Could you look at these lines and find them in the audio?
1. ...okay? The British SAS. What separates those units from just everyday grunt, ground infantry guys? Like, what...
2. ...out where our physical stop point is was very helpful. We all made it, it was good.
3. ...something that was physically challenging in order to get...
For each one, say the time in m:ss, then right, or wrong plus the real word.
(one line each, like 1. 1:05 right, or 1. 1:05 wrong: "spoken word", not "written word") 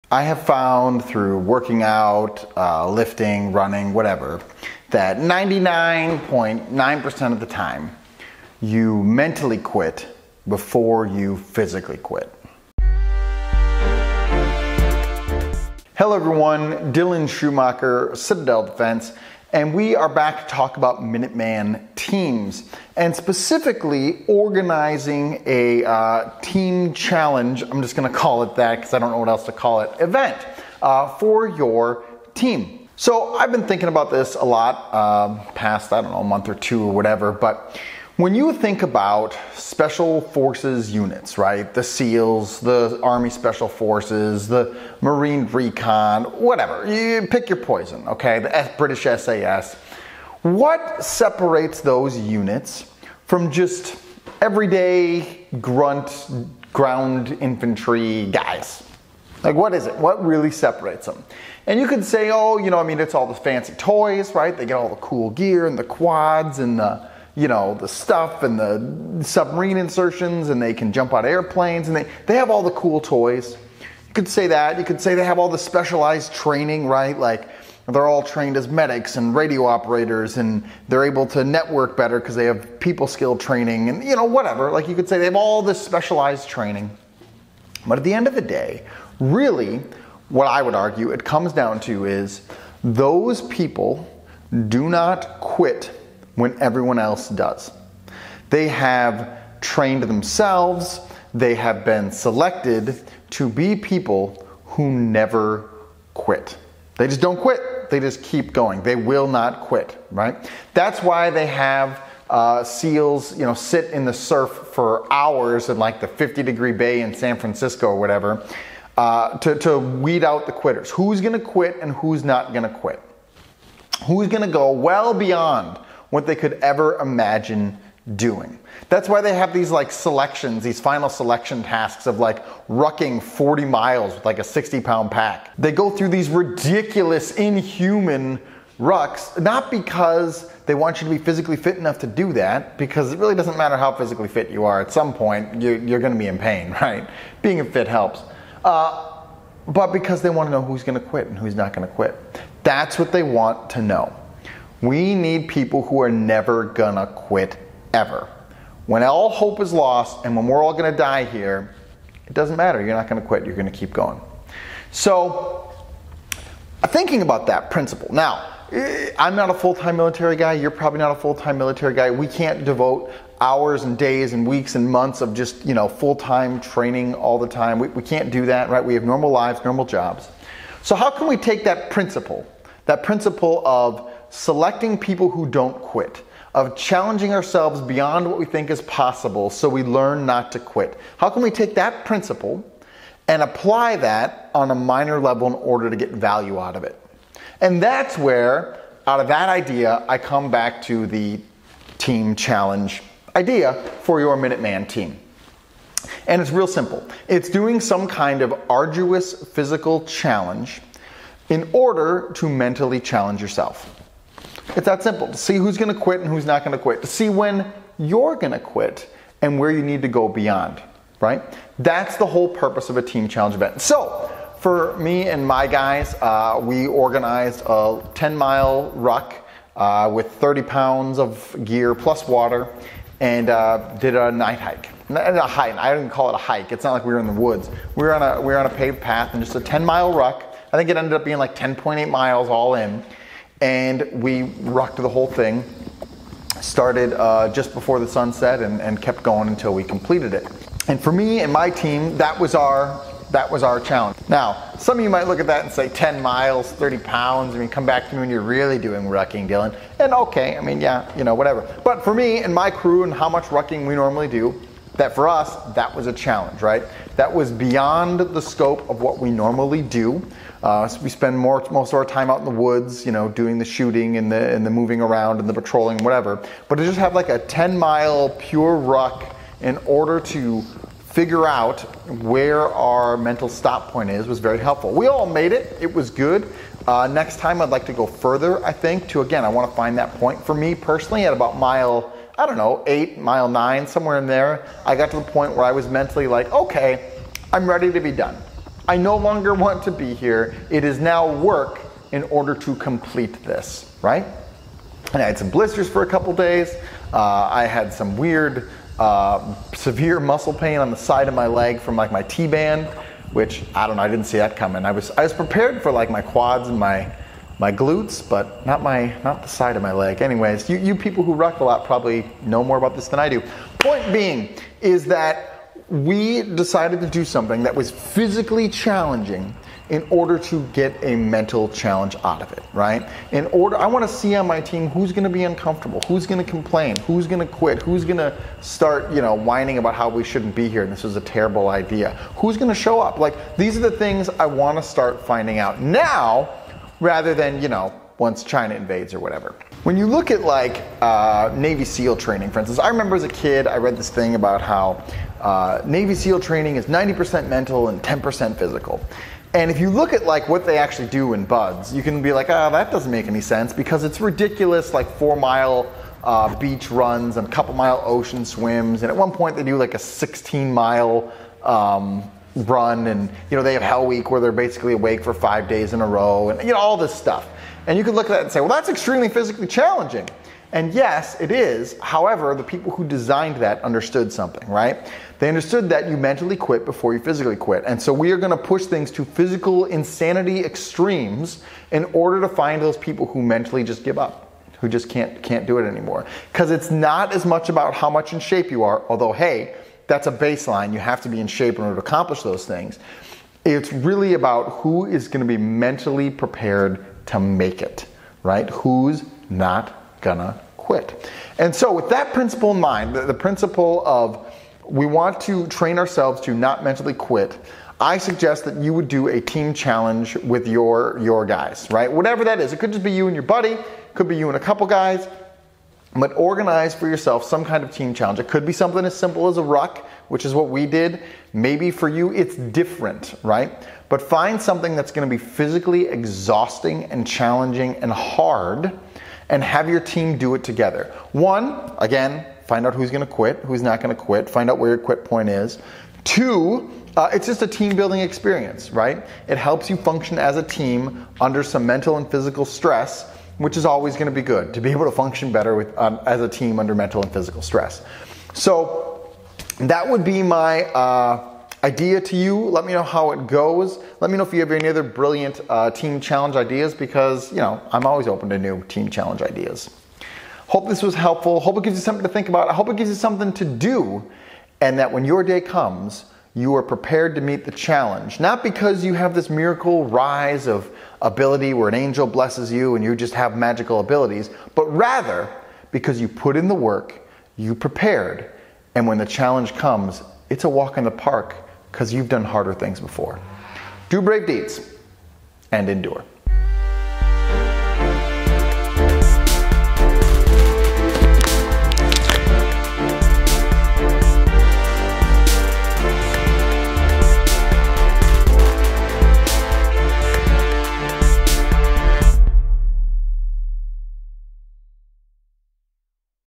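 1. 0:48 right
2. 4:41 wrong: "mental", not "physical"
3. 5:27 right.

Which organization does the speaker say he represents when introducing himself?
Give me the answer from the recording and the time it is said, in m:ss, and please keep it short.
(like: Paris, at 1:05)
Citadel Defense, at 0:18.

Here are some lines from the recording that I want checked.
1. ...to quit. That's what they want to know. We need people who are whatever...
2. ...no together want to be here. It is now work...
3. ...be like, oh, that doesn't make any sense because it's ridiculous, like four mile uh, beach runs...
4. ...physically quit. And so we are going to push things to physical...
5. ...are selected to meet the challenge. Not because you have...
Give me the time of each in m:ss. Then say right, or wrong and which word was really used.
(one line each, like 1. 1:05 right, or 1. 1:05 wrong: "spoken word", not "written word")
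1. 2:31 wrong: "never", not "whatever"
2. 4:58 wrong: "longer", not "together"
3. 6:02 right
4. 6:27 right
5. 7:56 wrong: "prepared", not "selected".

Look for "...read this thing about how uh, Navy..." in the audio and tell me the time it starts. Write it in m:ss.
5:53.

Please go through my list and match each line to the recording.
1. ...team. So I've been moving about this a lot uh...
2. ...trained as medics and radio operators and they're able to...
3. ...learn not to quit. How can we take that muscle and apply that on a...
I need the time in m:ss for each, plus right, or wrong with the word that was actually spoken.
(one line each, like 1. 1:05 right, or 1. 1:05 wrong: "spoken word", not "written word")
1. 0:32 wrong: "thinking", not "moving"
2. 1:18 right
3. 3:09 wrong: "principle", not "muscle".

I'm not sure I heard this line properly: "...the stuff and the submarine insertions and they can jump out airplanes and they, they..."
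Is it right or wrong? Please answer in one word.
right.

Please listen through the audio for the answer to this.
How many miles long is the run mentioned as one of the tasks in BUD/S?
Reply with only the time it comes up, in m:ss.
6:09.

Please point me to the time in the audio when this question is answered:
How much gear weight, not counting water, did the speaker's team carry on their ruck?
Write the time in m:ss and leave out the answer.
3:50.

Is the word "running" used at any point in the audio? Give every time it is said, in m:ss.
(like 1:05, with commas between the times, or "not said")
0:03.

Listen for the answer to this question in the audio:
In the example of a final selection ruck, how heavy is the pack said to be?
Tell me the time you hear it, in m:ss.
2:14.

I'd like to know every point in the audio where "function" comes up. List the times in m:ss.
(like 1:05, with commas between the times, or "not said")
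7:29, 7:35.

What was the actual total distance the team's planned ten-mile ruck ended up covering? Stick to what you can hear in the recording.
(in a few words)
10.8 miles.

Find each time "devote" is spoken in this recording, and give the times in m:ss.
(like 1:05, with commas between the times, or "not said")
2:52.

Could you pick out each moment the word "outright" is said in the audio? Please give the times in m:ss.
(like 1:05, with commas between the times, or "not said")
not said.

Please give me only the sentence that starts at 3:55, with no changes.
Not a hike, I didn't call it a hike.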